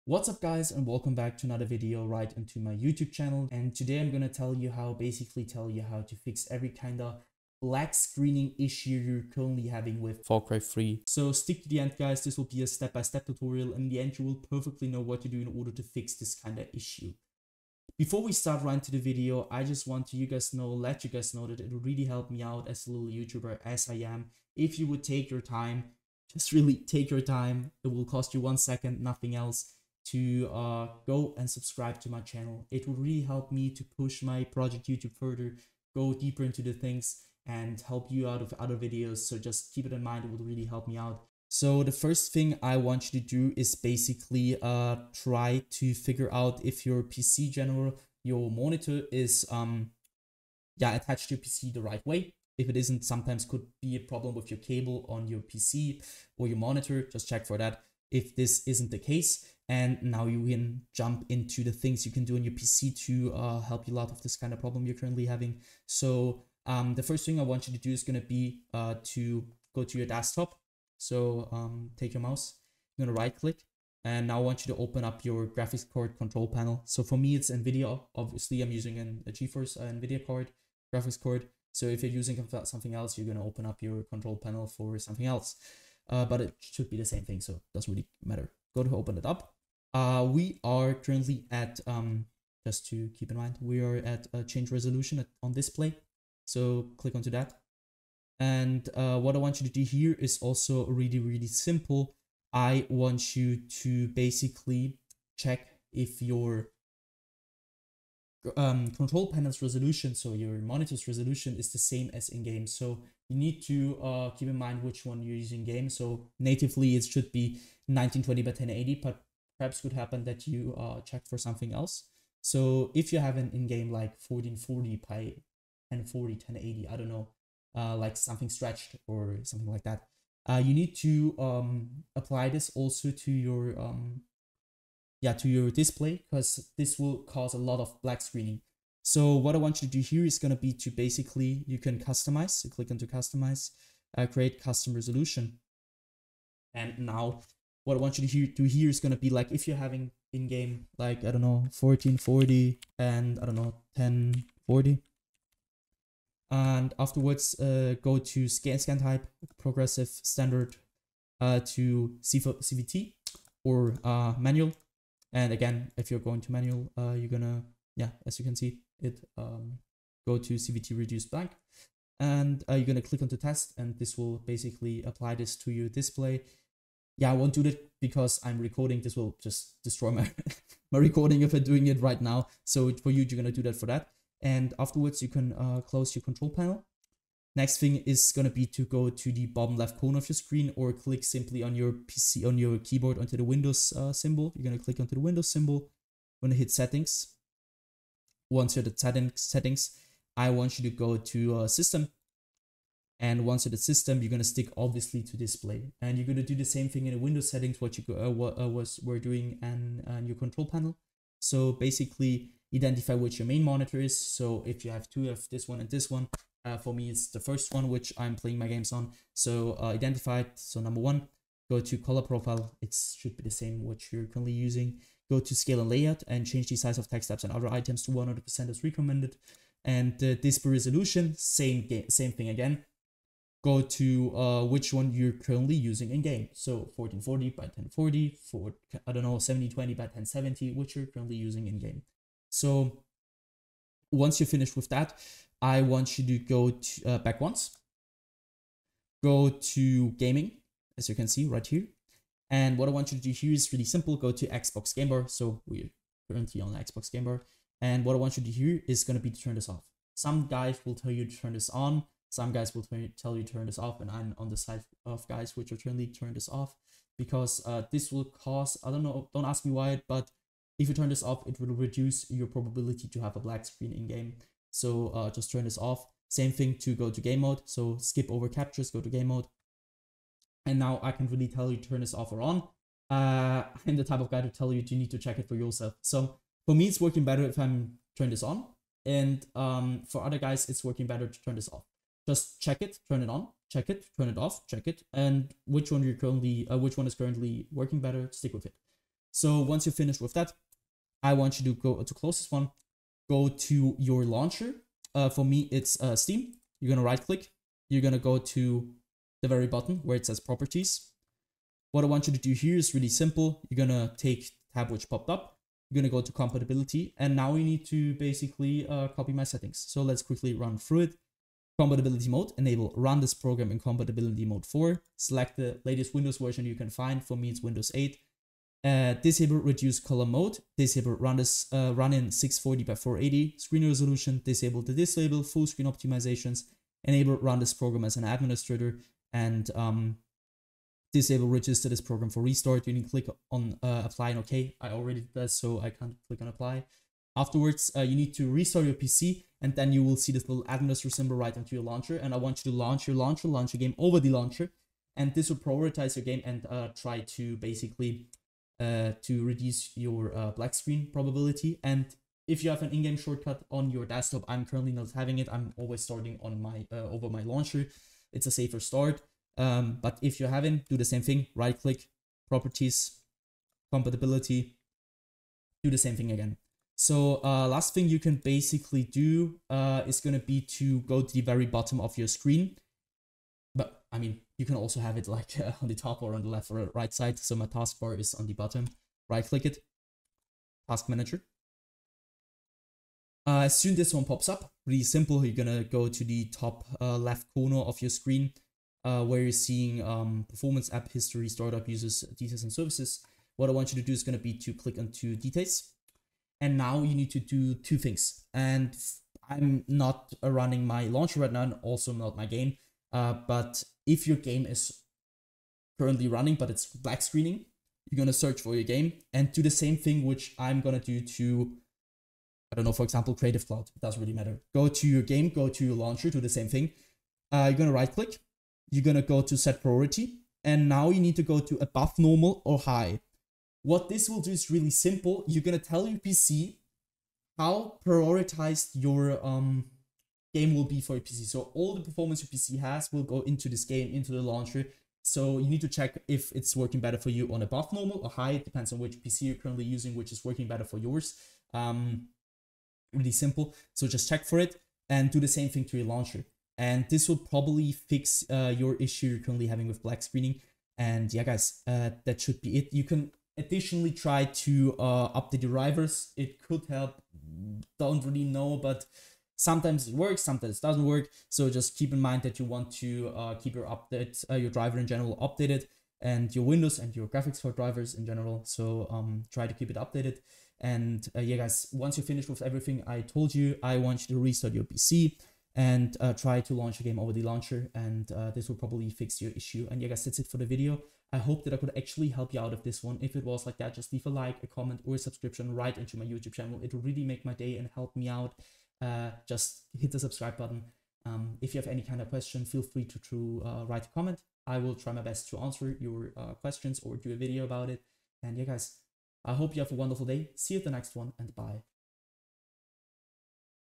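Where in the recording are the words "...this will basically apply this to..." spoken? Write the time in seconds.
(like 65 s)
173 s.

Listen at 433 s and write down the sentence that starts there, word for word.
What this will do is really simple.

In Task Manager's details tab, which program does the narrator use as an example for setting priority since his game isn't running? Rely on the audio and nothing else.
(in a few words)
Creative Cloud.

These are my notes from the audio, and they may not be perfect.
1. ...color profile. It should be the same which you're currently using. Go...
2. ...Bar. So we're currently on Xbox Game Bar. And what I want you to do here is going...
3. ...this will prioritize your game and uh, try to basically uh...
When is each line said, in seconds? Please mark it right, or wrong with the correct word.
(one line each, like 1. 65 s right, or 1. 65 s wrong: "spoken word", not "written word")
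1. 221 s right
2. 255 s right
3. 355 s right.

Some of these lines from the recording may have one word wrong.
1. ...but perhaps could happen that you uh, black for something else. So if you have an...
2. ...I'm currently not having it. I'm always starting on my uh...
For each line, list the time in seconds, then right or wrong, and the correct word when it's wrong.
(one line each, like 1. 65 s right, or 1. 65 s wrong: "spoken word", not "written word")
1. 119 s wrong: "check", not "black"
2. 364 s right.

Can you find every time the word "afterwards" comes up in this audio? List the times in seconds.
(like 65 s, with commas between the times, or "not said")
156 s, 184 s, 347 s.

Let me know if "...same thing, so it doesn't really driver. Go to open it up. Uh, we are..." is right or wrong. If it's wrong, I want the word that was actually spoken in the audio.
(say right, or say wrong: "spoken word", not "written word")
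wrong: "matter", not "driver".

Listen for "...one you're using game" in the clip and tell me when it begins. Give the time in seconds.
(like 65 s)
115 s.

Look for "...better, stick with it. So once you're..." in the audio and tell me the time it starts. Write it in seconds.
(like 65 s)
297 s.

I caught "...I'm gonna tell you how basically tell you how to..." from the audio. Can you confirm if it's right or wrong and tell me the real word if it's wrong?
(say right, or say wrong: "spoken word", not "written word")
right.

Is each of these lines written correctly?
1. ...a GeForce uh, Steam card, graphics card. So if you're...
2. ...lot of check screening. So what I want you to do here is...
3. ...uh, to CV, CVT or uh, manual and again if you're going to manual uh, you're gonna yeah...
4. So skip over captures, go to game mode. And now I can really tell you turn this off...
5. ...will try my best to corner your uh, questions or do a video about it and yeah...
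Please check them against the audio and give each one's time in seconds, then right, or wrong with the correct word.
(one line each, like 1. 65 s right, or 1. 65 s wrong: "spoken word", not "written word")
1. 79 s wrong: "NVIDIA", not "Steam"
2. 137 s wrong: "black", not "check"
3. 161 s right
4. 277 s right
5. 504 s wrong: "answer", not "corner".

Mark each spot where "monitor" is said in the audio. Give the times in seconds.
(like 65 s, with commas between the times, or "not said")
48 s, 56 s, 110 s, 213 s.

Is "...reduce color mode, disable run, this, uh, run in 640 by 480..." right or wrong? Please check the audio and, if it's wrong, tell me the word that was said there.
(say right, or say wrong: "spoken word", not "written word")
right.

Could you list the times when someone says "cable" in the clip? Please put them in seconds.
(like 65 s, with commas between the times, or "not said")
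54 s.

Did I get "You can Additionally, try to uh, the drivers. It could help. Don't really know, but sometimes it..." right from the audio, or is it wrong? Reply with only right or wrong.
right.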